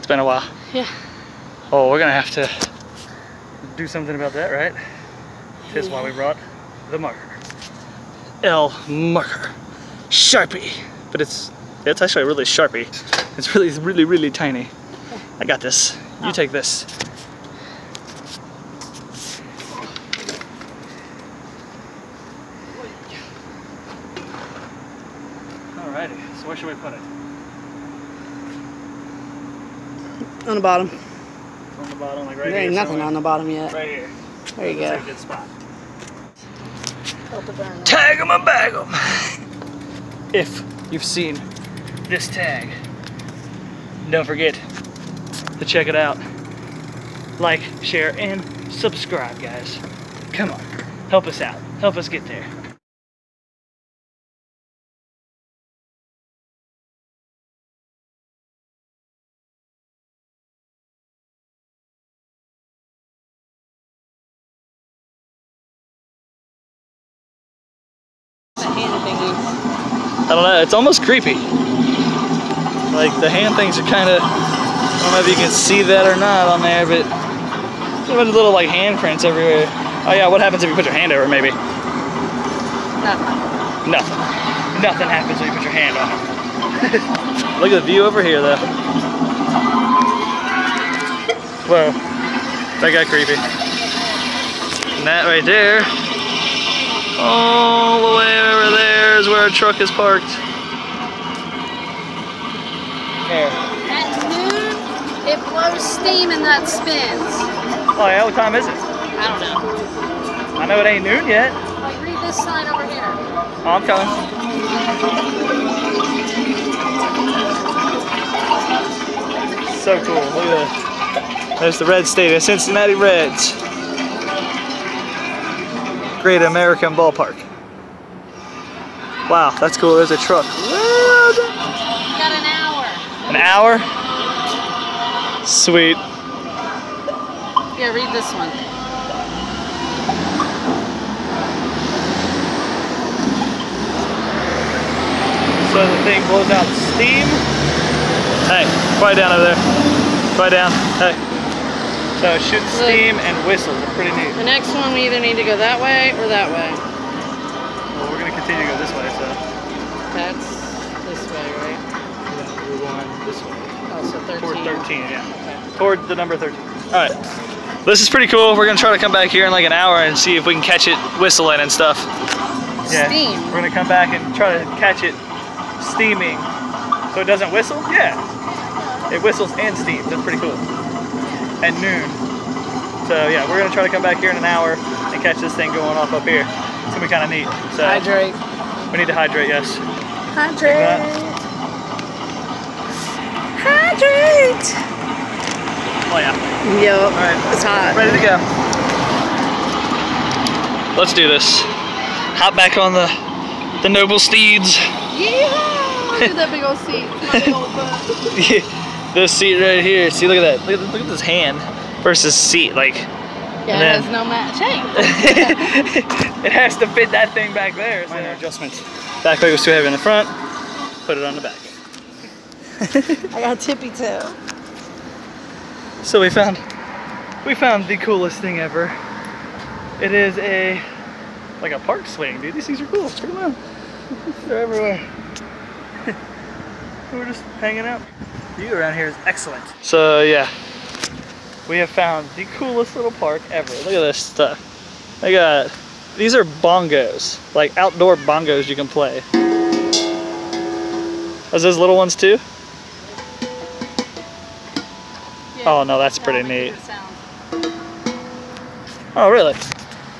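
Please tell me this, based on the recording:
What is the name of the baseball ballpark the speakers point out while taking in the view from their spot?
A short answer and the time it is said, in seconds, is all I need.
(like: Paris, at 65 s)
Great American Ballpark, at 126 s.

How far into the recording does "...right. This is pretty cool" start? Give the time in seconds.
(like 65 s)
167 s.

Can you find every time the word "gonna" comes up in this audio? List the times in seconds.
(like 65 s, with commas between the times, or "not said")
1 s.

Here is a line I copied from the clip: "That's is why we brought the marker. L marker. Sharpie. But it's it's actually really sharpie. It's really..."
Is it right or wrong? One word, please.
right.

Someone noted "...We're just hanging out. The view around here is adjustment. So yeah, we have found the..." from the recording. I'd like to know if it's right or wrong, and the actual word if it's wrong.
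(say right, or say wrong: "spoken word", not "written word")
wrong: "excellent", not "adjustment".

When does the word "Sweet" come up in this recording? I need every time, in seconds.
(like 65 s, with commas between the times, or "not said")
135 s.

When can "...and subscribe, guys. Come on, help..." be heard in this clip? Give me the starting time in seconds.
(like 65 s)
48 s.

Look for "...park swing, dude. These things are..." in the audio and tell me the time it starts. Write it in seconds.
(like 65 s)
231 s.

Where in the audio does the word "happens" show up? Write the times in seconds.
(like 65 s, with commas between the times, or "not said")
80 s, 85 s.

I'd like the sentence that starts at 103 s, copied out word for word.
At noon, it blows steam and that spins.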